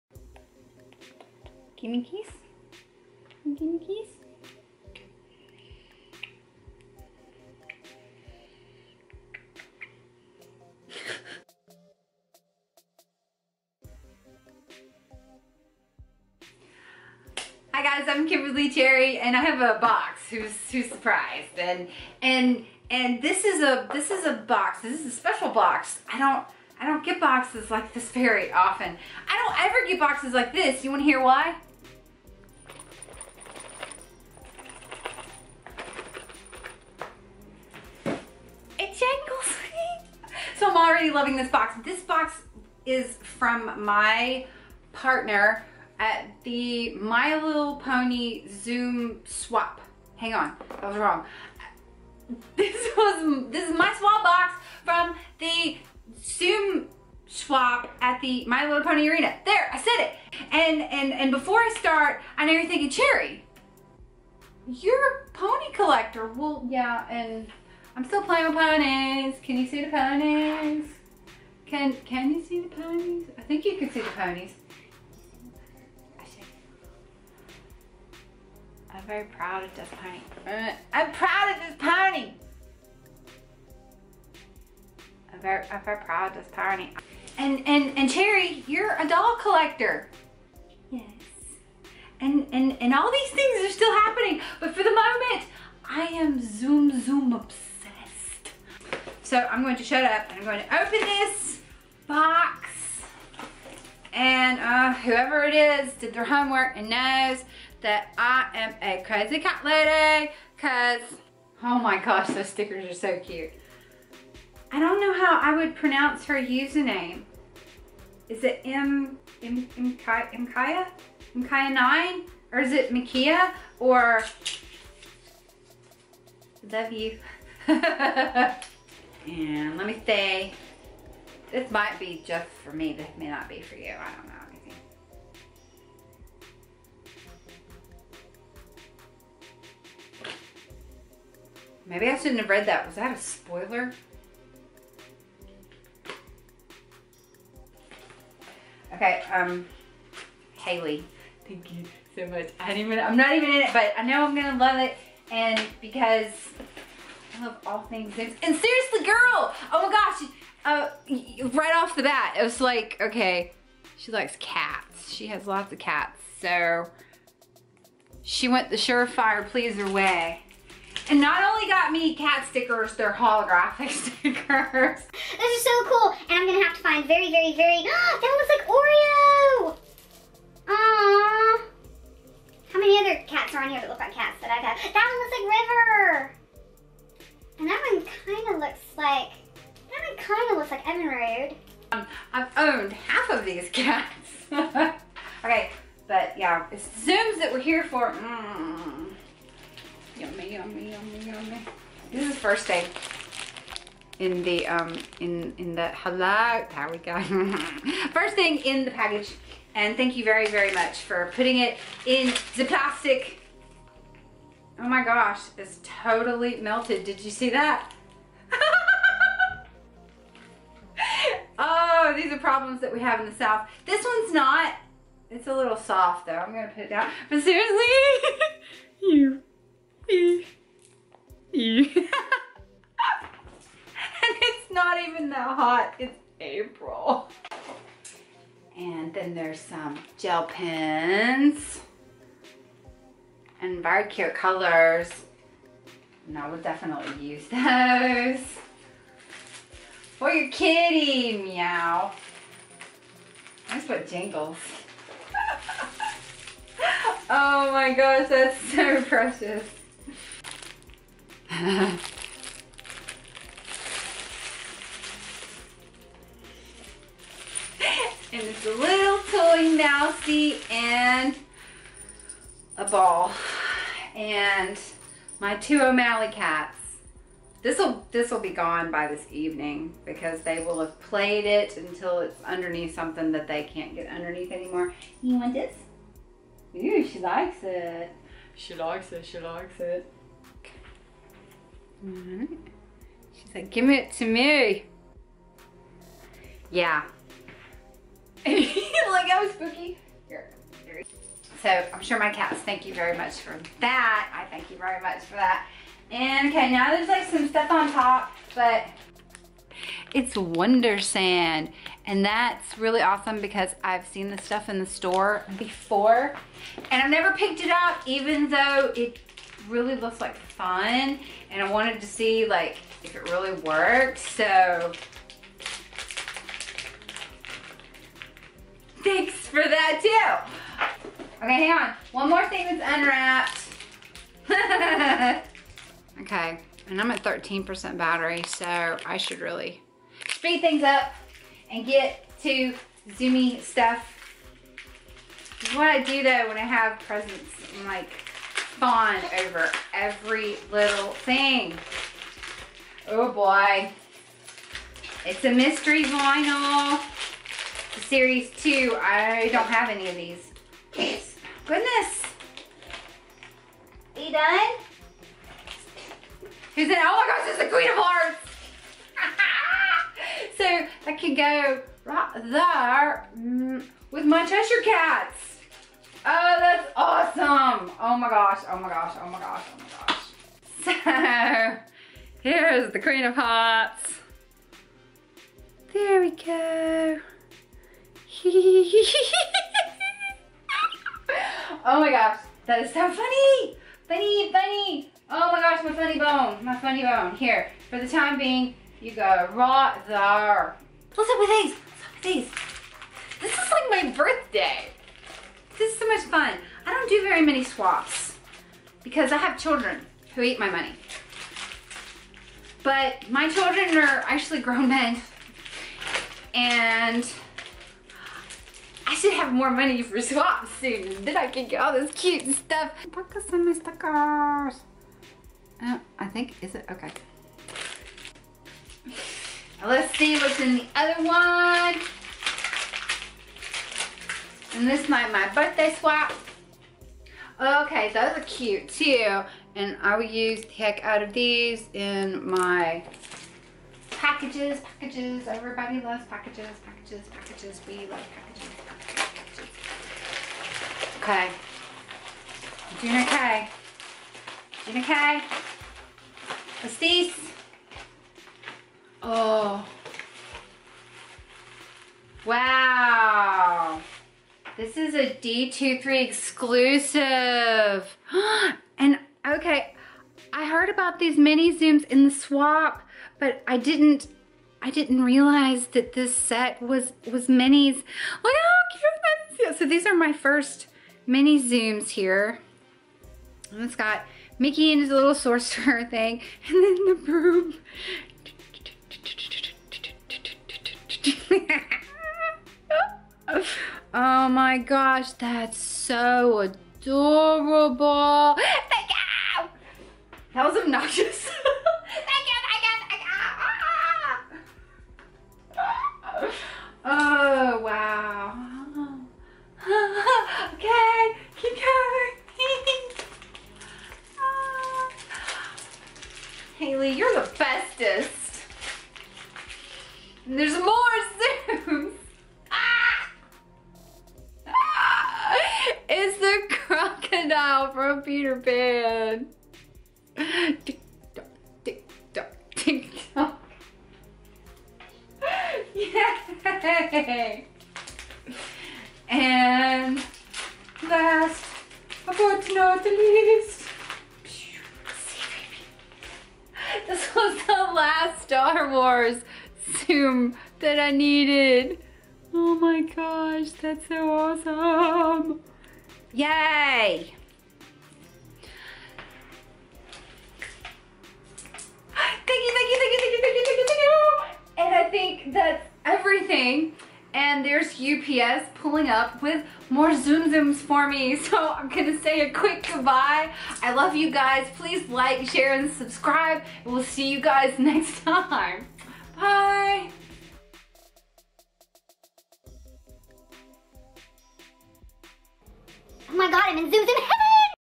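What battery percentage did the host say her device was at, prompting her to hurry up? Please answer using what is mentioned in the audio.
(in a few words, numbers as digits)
13%.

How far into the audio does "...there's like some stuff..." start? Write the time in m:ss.
5:06.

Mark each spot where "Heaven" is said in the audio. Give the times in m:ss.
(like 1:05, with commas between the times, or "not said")
9:47.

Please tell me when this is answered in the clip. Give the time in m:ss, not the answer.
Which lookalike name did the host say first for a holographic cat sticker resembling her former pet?
2:58.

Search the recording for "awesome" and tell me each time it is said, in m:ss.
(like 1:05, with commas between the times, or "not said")
5:13, 6:16, 9:14.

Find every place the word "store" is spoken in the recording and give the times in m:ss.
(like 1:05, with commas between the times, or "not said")
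5:14.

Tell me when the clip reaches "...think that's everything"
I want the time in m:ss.
9:25.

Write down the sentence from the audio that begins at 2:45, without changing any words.
She has lots of cats, so she went the surefire pleaser way.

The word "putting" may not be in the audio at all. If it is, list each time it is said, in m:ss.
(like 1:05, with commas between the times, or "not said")
3:31.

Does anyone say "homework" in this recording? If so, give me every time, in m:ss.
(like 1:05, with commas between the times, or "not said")
1:46.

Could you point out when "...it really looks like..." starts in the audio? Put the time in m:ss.
5:18.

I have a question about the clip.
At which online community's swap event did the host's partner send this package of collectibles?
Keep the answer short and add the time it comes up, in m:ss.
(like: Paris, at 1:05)
My Little Pony Arena, at 0:58.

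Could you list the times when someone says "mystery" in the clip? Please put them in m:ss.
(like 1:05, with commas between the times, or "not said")
5:55.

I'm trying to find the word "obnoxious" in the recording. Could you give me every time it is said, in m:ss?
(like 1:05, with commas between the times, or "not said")
8:20.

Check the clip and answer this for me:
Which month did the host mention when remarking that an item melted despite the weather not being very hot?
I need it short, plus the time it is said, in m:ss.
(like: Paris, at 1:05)
April, at 3:56.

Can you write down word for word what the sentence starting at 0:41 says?
This box is from my partner at the My Little Pony Tsum swap.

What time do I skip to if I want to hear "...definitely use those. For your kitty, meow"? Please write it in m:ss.
4:06.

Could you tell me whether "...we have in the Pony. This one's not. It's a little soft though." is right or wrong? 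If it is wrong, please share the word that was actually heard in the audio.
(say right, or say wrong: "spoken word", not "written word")
wrong: "South", not "Pony".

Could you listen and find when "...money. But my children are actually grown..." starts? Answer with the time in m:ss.
6:50.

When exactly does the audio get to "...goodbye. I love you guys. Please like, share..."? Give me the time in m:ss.
9:32.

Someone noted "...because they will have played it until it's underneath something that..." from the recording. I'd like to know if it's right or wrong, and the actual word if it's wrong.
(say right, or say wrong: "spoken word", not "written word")
right.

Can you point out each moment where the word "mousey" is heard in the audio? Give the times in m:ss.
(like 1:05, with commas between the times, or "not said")
4:29.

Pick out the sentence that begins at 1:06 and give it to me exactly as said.
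Well, yeah, and I'm still playing with ponies.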